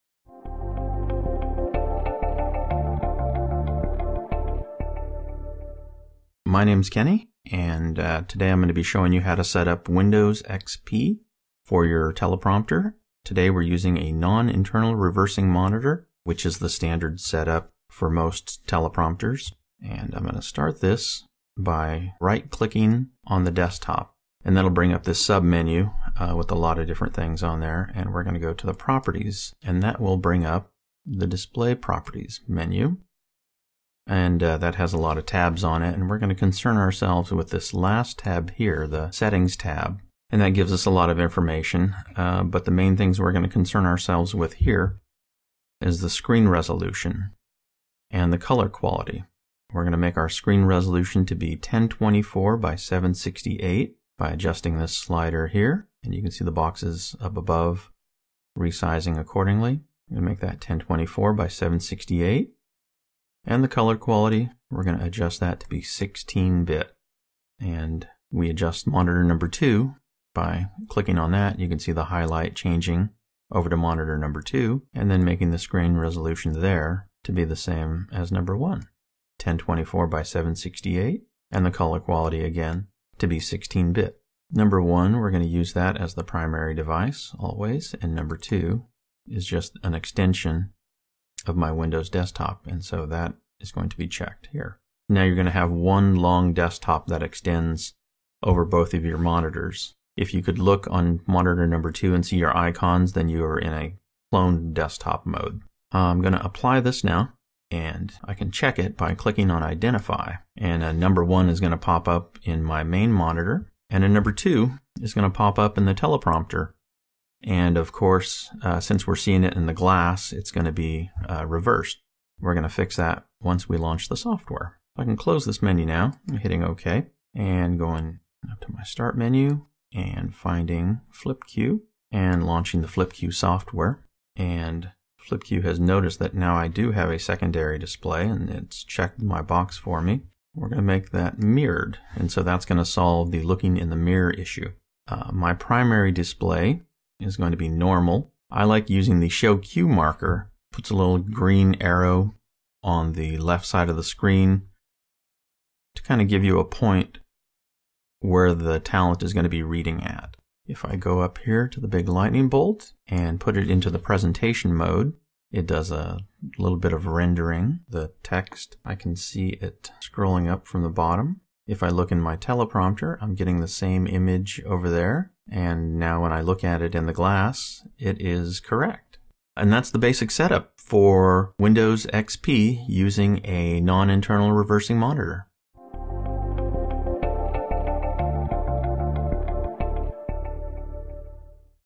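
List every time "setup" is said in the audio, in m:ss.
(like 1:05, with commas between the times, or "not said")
0:17, 3:00.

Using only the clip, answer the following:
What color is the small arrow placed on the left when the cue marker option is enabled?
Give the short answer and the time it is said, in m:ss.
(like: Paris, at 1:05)
Green, at 2:31.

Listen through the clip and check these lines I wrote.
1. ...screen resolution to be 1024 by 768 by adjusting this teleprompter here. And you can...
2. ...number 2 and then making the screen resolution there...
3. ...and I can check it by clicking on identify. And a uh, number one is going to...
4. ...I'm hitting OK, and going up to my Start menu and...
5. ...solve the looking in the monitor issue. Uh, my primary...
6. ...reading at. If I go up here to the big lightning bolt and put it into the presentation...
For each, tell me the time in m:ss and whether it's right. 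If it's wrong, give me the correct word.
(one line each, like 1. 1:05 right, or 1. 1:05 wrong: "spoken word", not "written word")
1. 0:50 wrong: "slider", not "teleprompter"
2. 1:14 right
3. 1:47 right
4. 2:06 right
5. 2:22 wrong: "mirror", not "monitor"
6. 2:39 right.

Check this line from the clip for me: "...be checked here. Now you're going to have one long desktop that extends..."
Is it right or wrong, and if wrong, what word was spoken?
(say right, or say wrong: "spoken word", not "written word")
right.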